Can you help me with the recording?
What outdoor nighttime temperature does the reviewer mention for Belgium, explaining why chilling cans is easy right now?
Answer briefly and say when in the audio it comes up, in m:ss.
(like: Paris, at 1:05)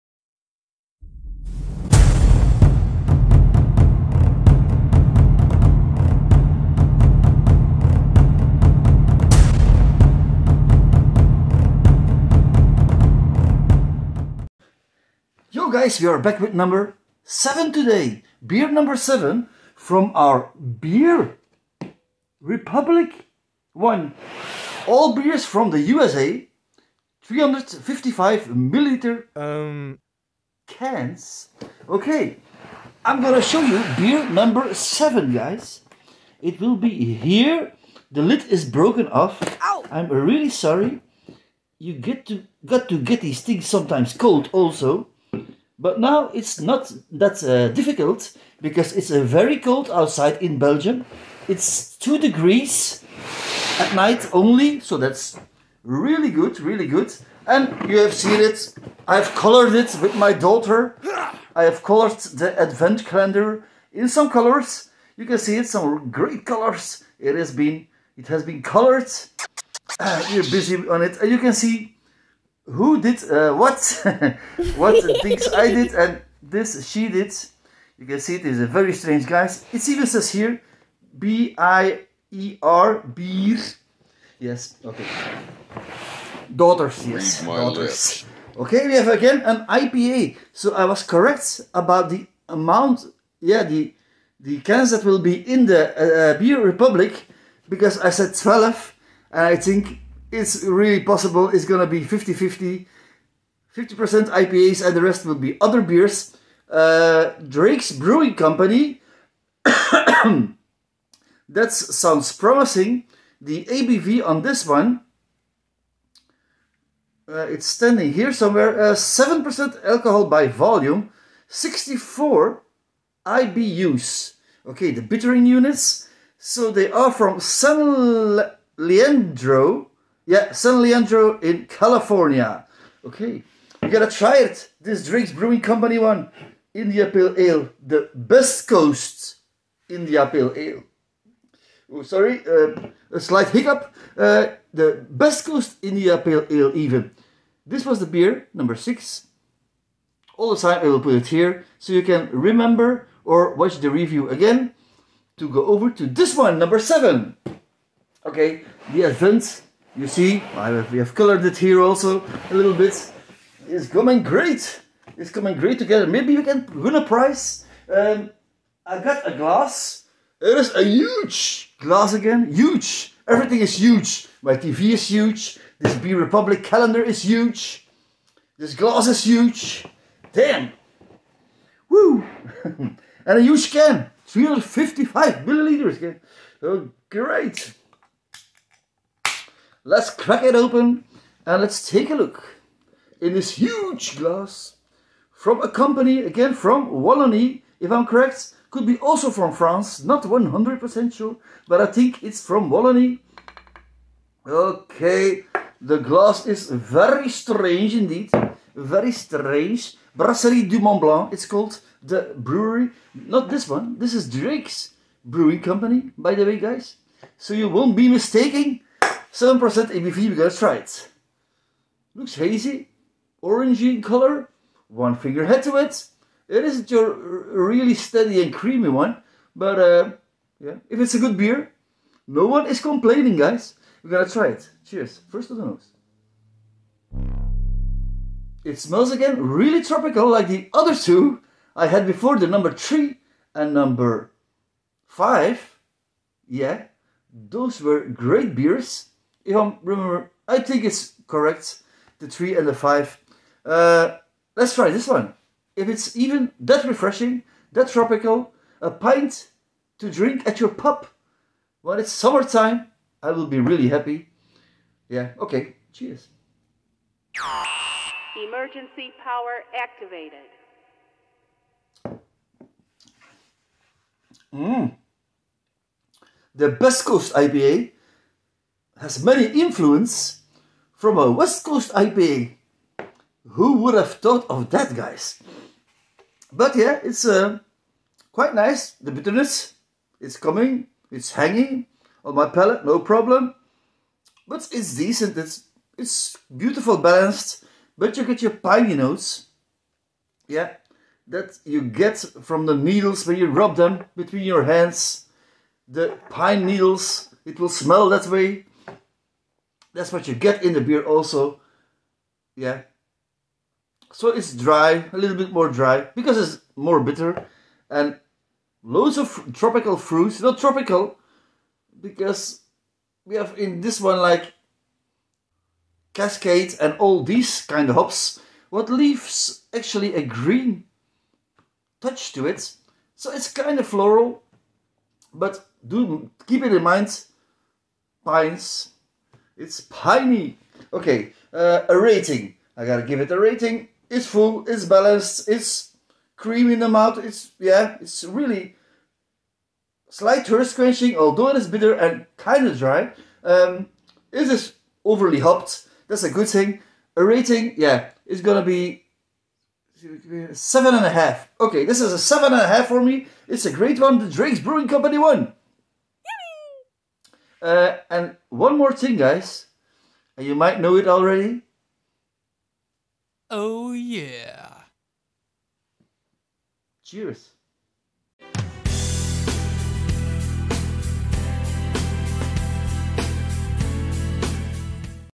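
2 degrees, at 0:51.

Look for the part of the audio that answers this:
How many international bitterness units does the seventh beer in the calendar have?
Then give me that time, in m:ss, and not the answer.
2:01.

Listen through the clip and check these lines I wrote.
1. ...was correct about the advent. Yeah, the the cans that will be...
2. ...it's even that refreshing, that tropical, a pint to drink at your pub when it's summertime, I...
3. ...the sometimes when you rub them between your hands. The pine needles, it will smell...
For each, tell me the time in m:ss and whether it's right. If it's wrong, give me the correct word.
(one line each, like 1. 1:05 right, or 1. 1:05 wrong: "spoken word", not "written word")
1. 1:30 wrong: "amount", not "advent"
2. 4:15 right
3. 5:02 wrong: "needles", not "sometimes".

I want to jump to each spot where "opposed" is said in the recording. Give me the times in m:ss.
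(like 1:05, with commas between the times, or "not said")
not said.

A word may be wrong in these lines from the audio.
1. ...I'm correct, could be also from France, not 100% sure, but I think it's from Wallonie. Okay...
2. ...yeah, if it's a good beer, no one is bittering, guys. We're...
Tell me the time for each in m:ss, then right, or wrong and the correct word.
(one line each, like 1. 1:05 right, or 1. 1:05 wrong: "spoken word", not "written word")
1. 3:17 right
2. 3:50 wrong: "complaining", not "bittering".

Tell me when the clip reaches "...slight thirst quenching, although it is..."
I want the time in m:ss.
5:50.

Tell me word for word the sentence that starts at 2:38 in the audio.
Okay, the advent you see, have, we have colored it here also a little bit.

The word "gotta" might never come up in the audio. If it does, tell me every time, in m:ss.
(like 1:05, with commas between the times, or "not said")
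2:13, 5:42.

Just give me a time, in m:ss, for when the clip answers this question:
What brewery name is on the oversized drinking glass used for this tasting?
3:30.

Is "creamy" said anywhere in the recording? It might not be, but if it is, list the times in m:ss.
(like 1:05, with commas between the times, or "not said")
3:48, 5:46.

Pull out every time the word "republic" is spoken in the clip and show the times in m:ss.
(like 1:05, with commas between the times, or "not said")
0:22, 1:36, 2:56.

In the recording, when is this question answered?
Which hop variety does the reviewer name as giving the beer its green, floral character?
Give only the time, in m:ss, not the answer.
5:26.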